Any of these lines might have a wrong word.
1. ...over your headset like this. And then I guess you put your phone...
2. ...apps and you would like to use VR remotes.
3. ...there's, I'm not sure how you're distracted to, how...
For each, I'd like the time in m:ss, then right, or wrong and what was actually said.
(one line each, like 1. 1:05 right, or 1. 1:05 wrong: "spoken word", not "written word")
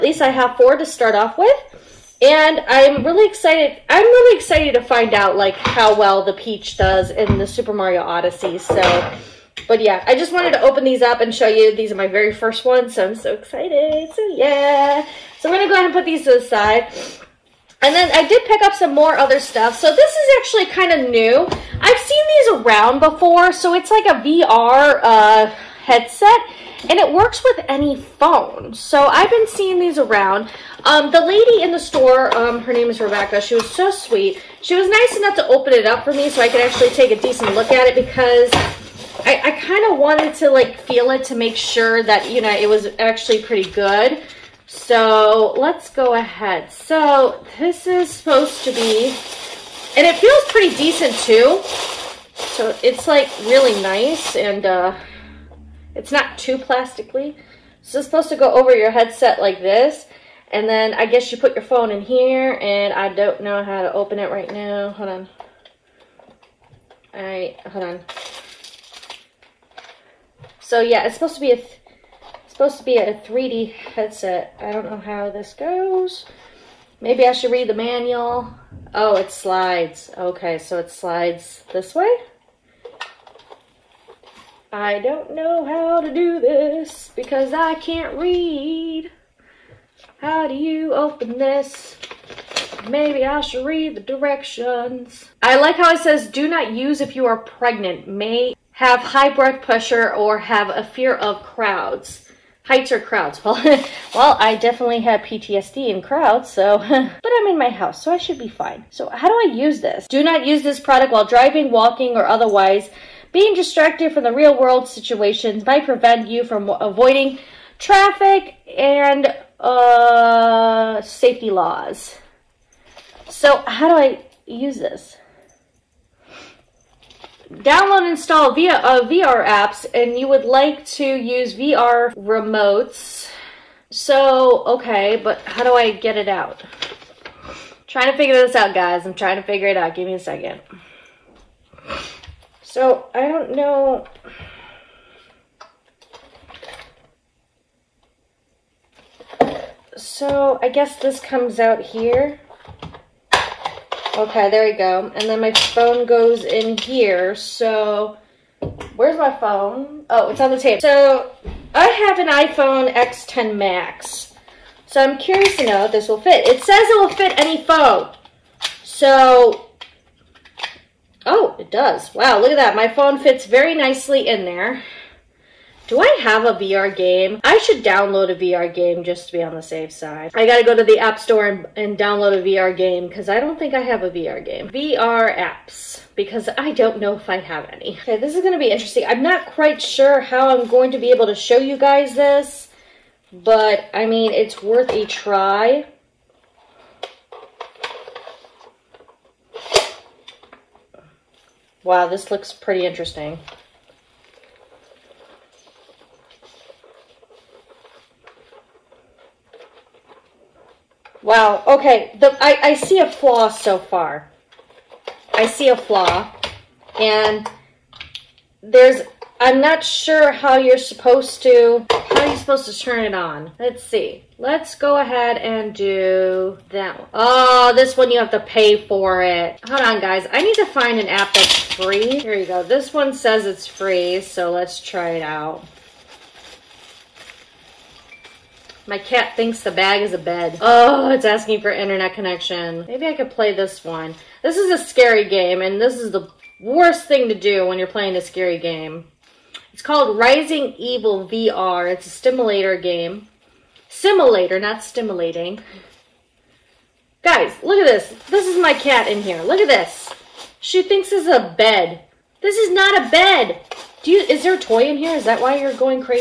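1. 0:58 right
2. 2:09 right
3. 3:38 wrong: "supposed", not "distracted".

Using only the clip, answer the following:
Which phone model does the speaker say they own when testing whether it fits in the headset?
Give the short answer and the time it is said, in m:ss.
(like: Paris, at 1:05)
iPhone X10 Max, at 2:42.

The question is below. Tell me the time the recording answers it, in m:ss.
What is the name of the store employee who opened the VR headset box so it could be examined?
0:32.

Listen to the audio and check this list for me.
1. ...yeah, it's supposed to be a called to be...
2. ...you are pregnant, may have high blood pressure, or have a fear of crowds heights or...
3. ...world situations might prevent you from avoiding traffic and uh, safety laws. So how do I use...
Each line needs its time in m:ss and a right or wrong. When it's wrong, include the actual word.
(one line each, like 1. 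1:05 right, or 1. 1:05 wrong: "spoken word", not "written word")
1. 1:10 wrong: "supposed", not "called"
2. 1:37 right
3. 1:54 right.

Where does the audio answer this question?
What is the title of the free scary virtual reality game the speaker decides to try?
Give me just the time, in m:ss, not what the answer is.
4:10.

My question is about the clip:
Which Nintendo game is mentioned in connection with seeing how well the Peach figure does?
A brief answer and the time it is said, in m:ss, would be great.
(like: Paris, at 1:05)
Super Mario Odyssey, at 0:07.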